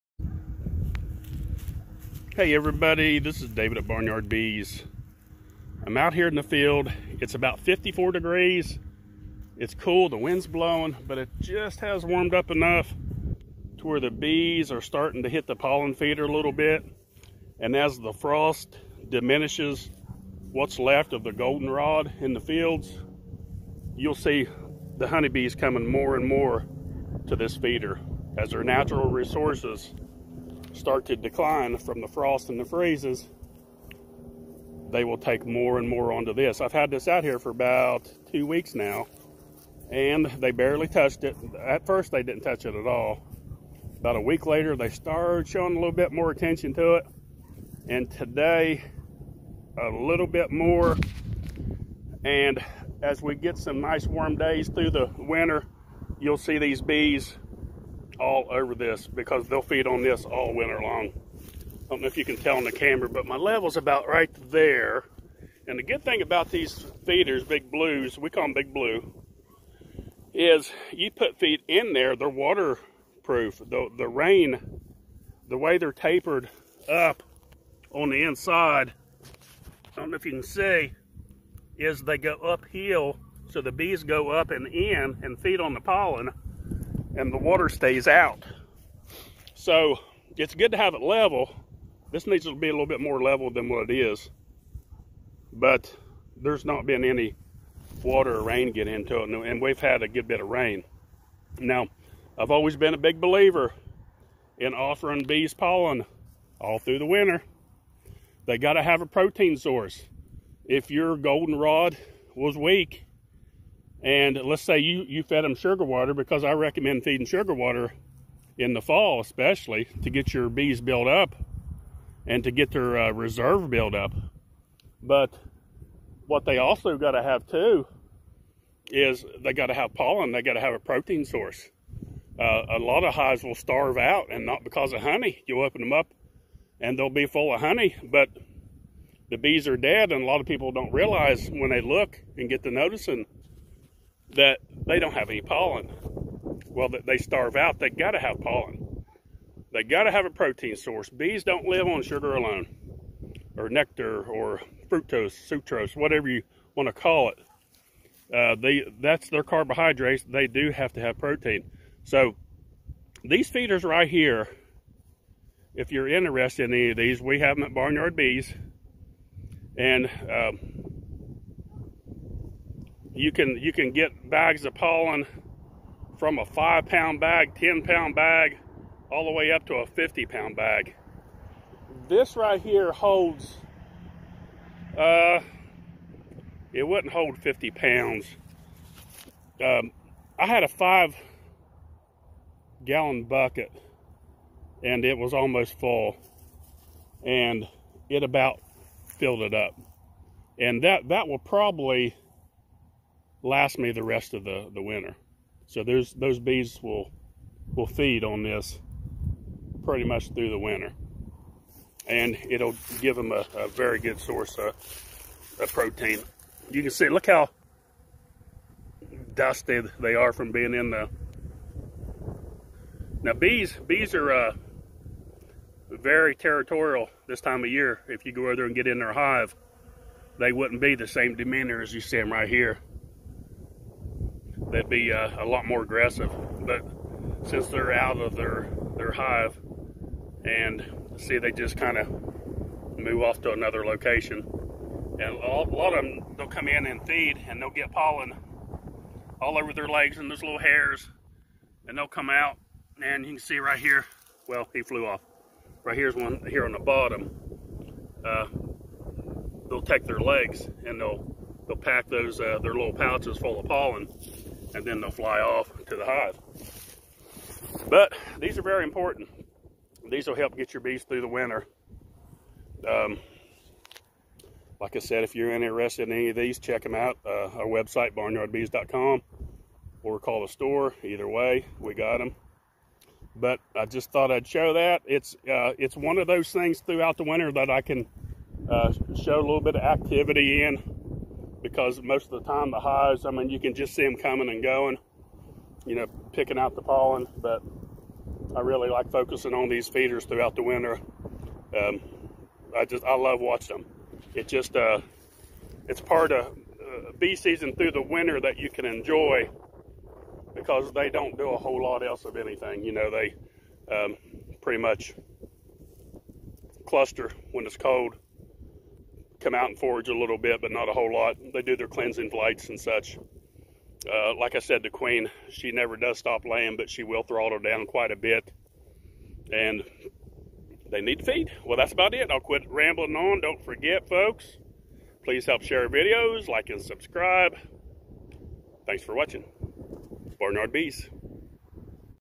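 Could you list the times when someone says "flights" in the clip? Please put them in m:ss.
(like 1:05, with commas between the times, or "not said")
5:22.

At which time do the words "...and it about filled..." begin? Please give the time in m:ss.
3:17.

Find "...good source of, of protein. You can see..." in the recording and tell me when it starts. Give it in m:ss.
3:33.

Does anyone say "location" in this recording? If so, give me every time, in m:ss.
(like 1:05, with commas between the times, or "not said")
4:03.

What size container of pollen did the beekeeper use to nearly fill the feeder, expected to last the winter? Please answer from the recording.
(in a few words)
five gallon bucket.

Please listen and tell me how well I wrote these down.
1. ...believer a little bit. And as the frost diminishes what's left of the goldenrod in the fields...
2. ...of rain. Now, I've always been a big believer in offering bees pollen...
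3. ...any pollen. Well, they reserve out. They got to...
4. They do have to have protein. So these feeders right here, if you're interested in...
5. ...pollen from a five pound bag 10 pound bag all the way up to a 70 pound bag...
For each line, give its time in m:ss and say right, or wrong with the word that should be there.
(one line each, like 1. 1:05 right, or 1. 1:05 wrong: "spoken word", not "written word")
1. 0:15 wrong: "feeder", not "believer"
2. 1:40 right
3. 2:25 wrong: "starve", not "reserve"
4. 2:40 right
5. 2:54 wrong: "50", not "70".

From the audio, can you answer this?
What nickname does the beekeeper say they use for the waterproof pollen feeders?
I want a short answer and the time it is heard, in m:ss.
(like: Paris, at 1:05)
big blue, at 1:08.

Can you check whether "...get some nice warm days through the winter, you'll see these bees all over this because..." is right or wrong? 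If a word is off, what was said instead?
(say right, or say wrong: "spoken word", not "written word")
right.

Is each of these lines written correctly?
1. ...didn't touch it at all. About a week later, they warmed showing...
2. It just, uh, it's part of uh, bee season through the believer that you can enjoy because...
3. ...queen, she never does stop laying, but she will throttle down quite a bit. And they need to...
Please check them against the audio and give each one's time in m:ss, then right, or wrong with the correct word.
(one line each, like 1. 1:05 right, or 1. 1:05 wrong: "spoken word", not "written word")
1. 0:42 wrong: "started", not "warmed"
2. 5:04 wrong: "winter", not "believer"
3. 5:24 right.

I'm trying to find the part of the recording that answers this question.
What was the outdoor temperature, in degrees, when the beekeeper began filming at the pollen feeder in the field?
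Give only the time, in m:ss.
0:07.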